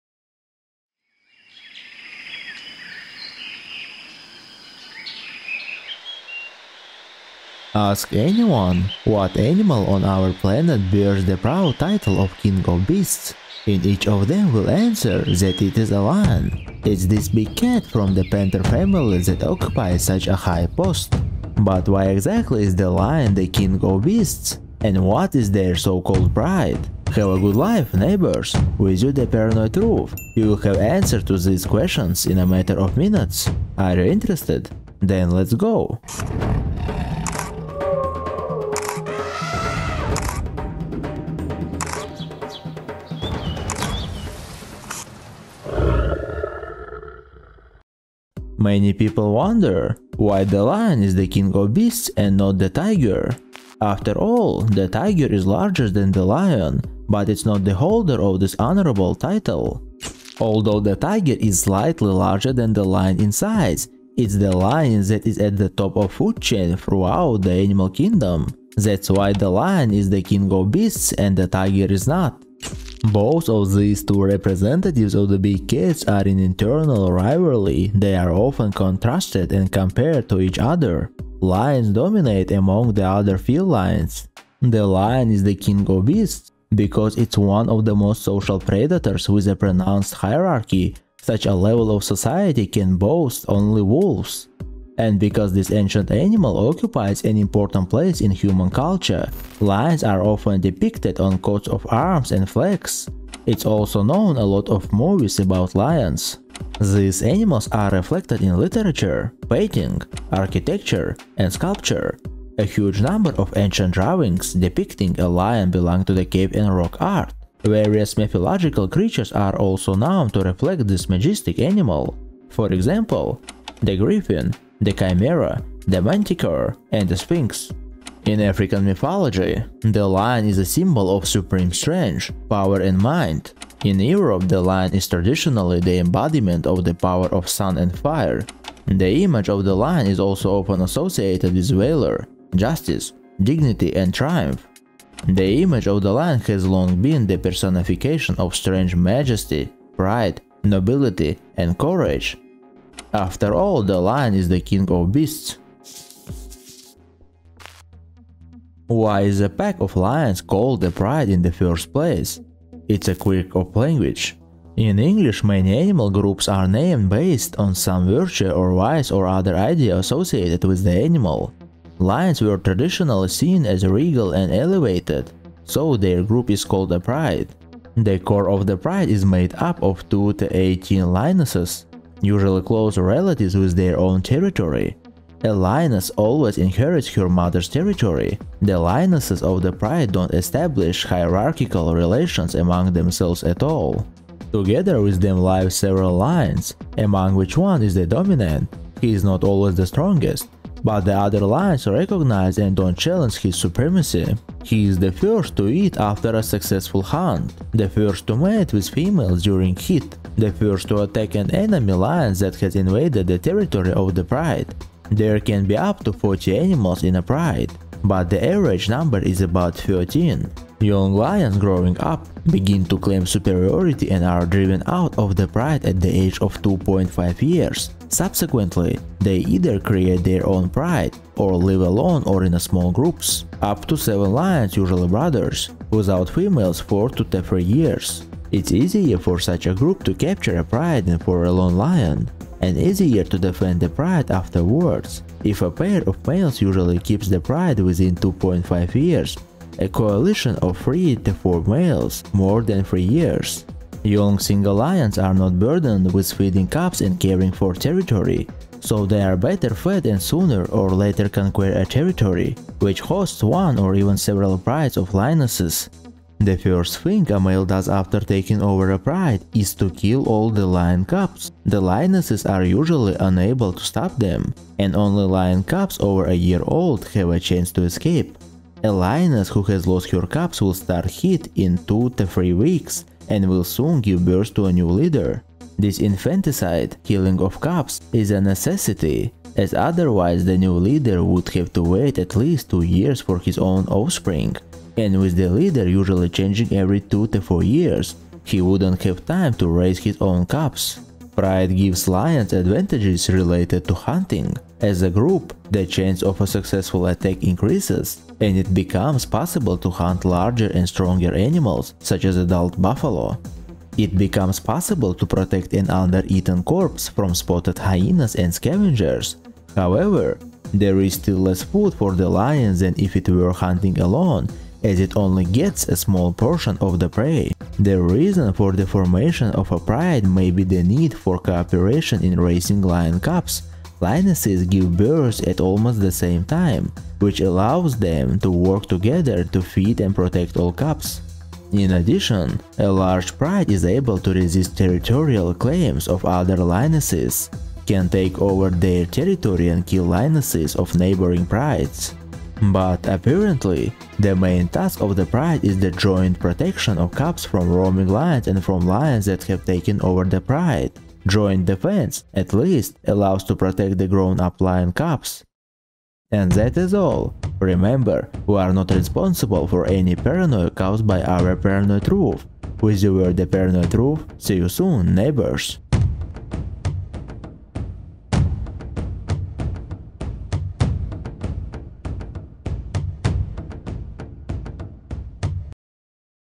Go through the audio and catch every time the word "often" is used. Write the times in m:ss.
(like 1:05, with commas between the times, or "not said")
1:18, 1:40, 2:20.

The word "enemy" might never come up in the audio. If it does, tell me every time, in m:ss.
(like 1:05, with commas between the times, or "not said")
3:31.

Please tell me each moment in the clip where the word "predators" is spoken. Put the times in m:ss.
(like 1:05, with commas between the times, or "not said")
1:28.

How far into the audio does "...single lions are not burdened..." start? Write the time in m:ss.
4:14.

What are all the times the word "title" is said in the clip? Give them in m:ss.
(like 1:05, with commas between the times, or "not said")
0:11, 0:59.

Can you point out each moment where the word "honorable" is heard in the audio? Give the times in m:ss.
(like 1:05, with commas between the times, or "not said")
0:58.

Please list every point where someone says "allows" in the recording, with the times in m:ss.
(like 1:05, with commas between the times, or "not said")
5:37, 6:03.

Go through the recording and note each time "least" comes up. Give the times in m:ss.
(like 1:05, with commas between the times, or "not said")
4:52, 6:02.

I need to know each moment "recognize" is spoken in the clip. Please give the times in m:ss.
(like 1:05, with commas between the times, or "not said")
3:21.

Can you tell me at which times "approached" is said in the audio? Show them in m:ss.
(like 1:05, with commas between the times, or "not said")
not said.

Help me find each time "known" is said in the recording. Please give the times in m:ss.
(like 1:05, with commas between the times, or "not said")
1:44, 1:59.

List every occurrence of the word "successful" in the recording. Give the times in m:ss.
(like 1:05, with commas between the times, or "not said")
3:26, 5:06.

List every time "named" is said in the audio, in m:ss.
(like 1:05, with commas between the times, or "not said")
2:46.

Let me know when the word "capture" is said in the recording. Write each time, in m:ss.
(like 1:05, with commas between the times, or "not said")
4:00.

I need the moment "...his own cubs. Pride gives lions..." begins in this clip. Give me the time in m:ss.
4:59.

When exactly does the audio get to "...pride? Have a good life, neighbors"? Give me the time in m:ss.
0:26.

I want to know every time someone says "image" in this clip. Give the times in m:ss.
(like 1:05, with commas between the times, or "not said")
2:19, 2:25.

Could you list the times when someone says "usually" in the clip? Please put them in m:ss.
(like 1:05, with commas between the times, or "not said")
3:02, 3:54, 4:06, 4:32, 4:55.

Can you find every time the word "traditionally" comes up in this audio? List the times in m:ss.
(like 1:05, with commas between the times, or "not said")
2:15, 2:52.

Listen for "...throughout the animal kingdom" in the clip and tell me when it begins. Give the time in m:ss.
1:06.